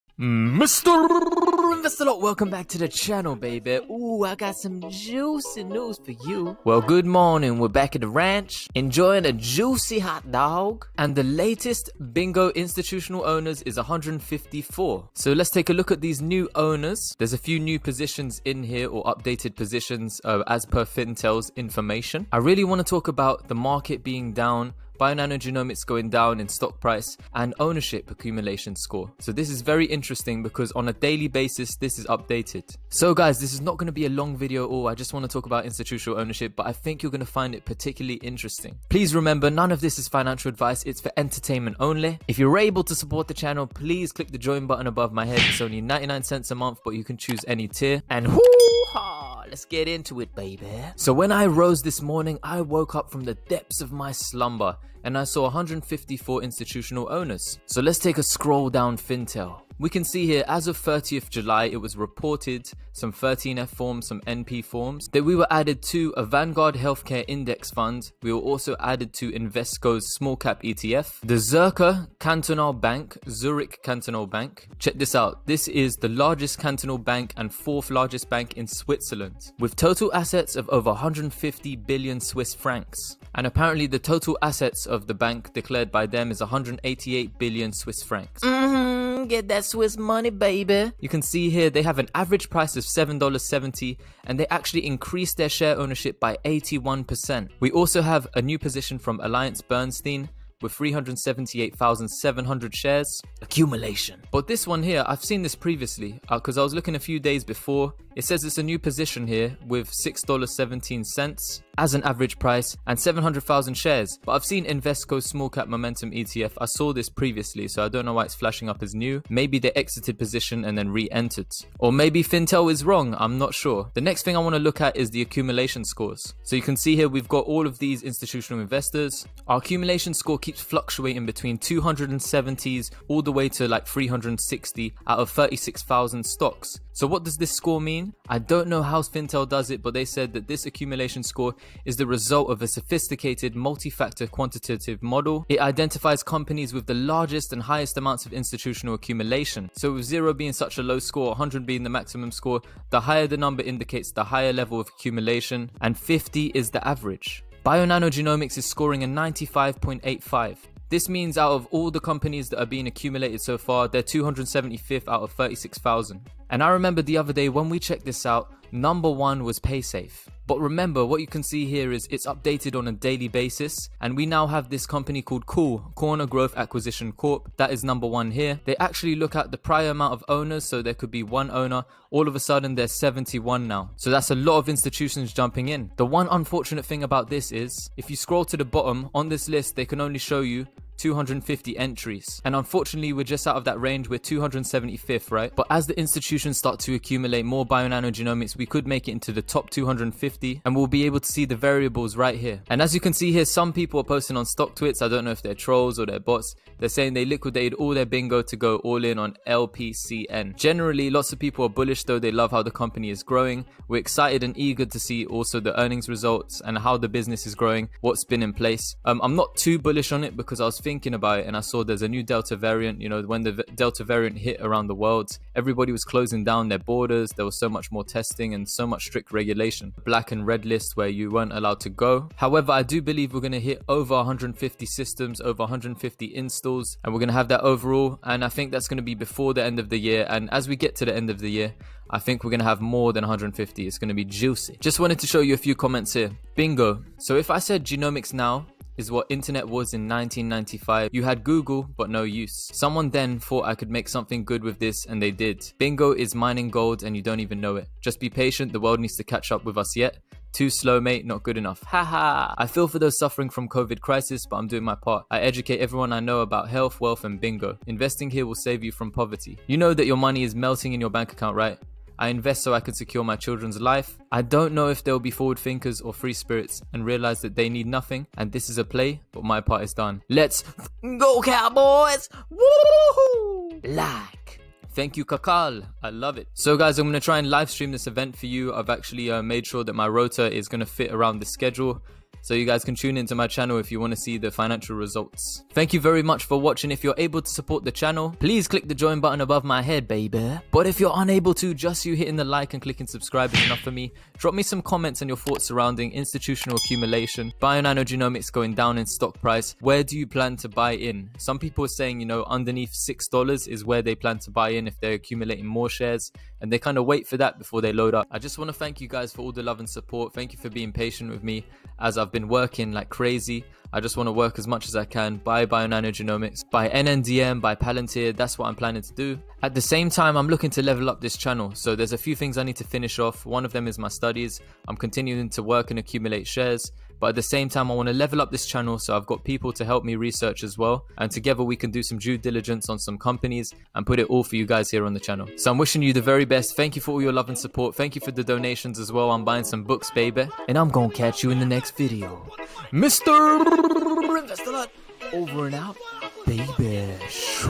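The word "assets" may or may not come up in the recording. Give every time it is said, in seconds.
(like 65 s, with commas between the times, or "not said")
80 s, 84 s.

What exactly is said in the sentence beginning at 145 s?
It identifies companies with the largest and highest amounts of institutional accumulation.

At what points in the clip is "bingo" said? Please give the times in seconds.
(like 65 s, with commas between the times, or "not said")
12 s, 208 s, 246 s, 255 s, 267 s.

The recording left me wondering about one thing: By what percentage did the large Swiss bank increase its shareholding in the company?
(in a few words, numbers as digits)
81%.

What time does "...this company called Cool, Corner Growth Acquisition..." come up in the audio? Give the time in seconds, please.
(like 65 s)
174 s.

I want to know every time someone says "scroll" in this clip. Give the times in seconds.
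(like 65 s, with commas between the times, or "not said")
58 s, 188 s.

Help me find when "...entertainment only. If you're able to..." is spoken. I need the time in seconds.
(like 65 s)
41 s.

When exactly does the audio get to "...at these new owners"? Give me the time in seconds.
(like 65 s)
15 s.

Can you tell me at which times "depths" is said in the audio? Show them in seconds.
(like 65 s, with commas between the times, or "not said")
53 s.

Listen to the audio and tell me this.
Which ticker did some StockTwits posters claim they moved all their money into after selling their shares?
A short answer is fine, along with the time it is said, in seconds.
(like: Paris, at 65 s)
LPCN, at 209 s.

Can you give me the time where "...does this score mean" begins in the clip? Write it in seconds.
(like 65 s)
137 s.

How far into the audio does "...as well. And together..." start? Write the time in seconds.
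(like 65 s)
340 s.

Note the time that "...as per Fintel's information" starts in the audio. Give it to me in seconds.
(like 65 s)
20 s.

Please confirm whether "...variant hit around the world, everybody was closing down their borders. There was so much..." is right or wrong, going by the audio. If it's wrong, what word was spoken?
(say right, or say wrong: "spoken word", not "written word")
right.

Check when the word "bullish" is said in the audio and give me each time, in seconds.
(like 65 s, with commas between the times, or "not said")
211 s, 219 s.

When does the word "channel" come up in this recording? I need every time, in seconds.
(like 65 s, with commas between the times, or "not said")
2 s, 43 s, 293 s, 297 s, 331 s, 338 s, 345 s.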